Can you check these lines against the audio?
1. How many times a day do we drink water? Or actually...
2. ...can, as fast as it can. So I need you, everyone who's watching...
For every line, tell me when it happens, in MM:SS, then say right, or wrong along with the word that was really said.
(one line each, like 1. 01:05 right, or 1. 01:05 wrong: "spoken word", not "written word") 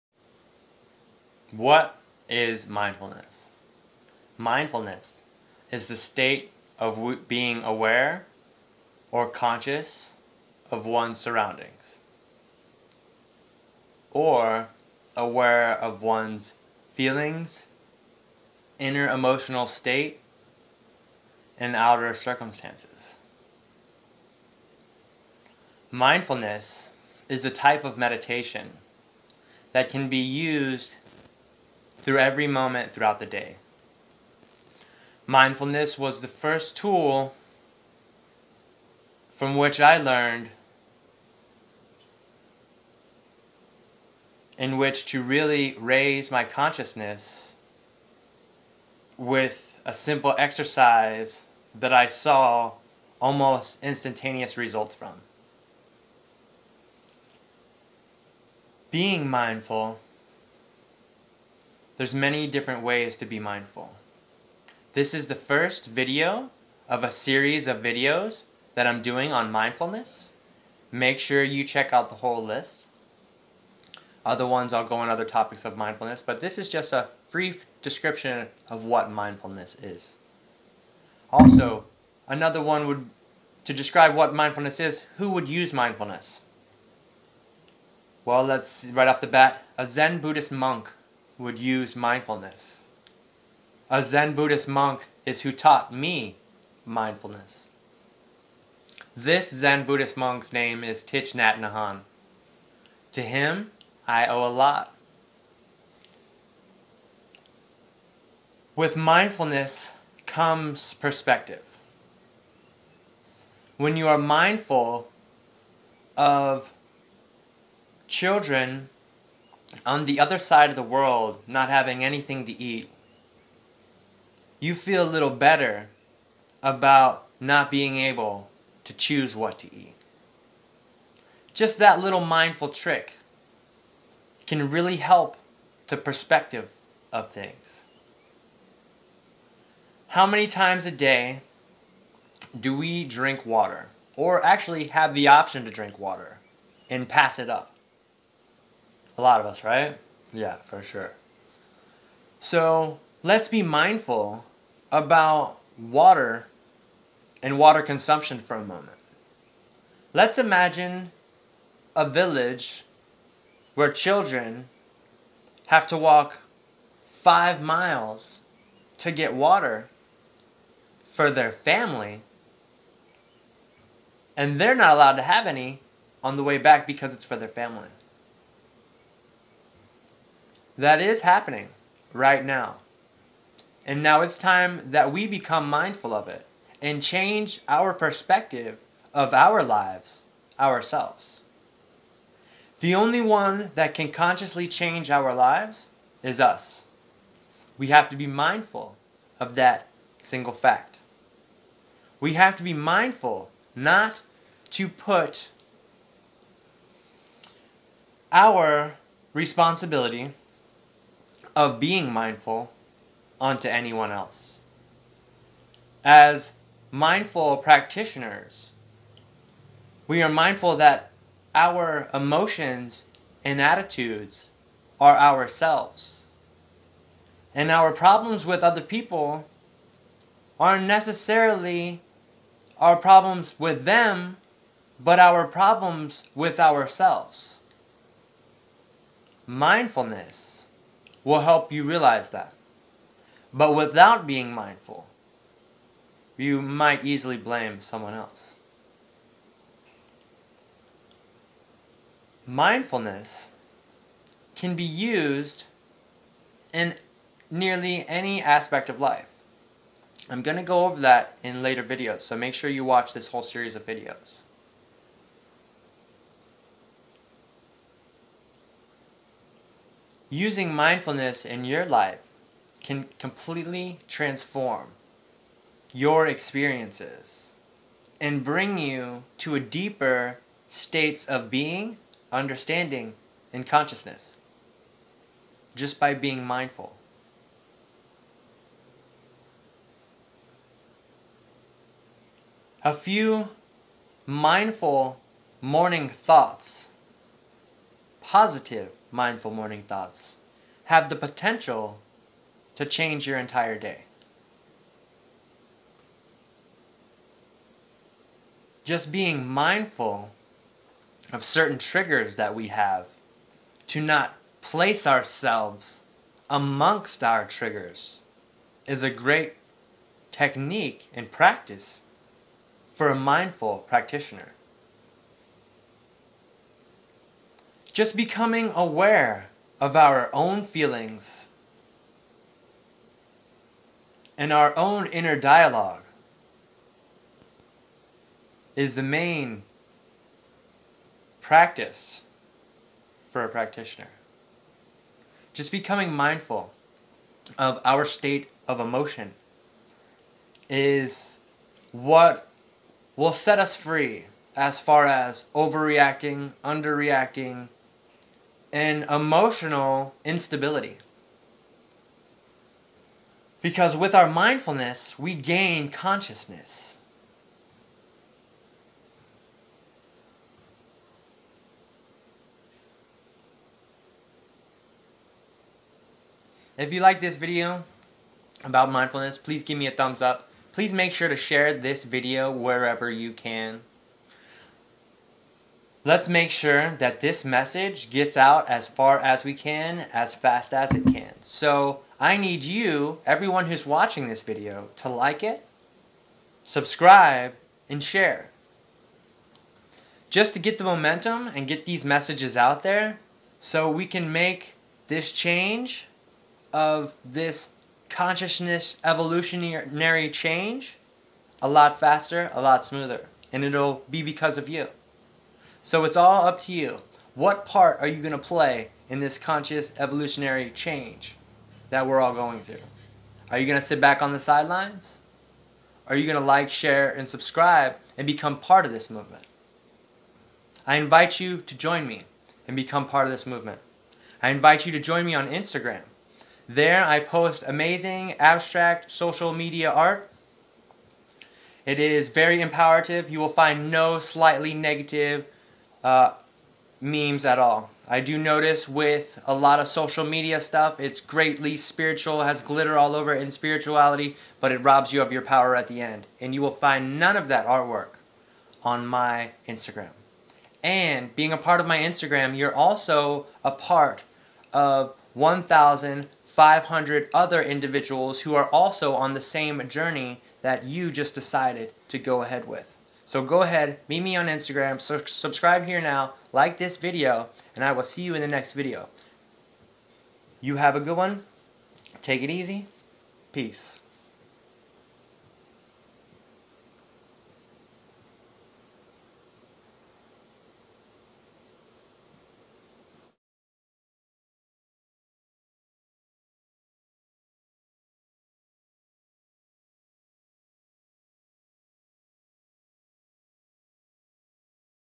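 1. 02:20 right
2. 06:29 right.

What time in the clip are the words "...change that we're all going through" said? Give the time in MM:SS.
07:00.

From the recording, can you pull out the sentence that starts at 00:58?
Being mindful there's many different ways to be mindful.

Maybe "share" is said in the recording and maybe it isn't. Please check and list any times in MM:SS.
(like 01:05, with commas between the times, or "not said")
06:21, 06:38, 07:06.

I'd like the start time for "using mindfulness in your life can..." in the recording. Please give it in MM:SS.
04:30.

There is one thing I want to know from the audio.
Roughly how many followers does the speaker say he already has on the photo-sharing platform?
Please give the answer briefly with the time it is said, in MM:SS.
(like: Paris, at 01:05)
1,500, at 07:45.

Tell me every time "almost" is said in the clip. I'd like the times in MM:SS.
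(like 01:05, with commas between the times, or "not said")
00:53.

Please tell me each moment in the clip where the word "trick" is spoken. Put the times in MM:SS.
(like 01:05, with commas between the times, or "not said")
02:12.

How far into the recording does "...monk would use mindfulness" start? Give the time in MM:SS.
01:30.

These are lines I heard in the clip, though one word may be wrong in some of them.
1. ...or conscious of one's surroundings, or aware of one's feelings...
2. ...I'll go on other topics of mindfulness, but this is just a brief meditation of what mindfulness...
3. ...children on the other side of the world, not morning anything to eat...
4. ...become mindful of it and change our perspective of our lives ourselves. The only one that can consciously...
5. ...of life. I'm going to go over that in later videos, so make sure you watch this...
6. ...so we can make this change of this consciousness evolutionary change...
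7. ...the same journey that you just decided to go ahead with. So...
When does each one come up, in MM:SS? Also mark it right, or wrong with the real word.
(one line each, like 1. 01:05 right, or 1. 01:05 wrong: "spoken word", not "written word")
1. 00:09 right
2. 01:14 wrong: "description", not "meditation"
3. 01:58 wrong: "having", not "morning"
4. 03:05 right
5. 04:18 right
6. 06:43 right
7. 07:49 right.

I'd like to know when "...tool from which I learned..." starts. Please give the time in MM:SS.
00:36.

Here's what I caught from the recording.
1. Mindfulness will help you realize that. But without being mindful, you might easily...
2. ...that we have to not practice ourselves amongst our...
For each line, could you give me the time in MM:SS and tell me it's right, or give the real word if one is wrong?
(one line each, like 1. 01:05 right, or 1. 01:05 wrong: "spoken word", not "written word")
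1. 03:59 right
2. 05:12 wrong: "place", not "practice".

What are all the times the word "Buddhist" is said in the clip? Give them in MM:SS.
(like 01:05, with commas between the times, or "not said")
01:30, 01:34, 01:39.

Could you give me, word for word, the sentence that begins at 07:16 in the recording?
There, I post amazing abstract social media art.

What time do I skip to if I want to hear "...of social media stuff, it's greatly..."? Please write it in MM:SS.
07:29.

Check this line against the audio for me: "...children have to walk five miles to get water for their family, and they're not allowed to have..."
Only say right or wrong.
right.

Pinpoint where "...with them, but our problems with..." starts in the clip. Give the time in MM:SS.
03:53.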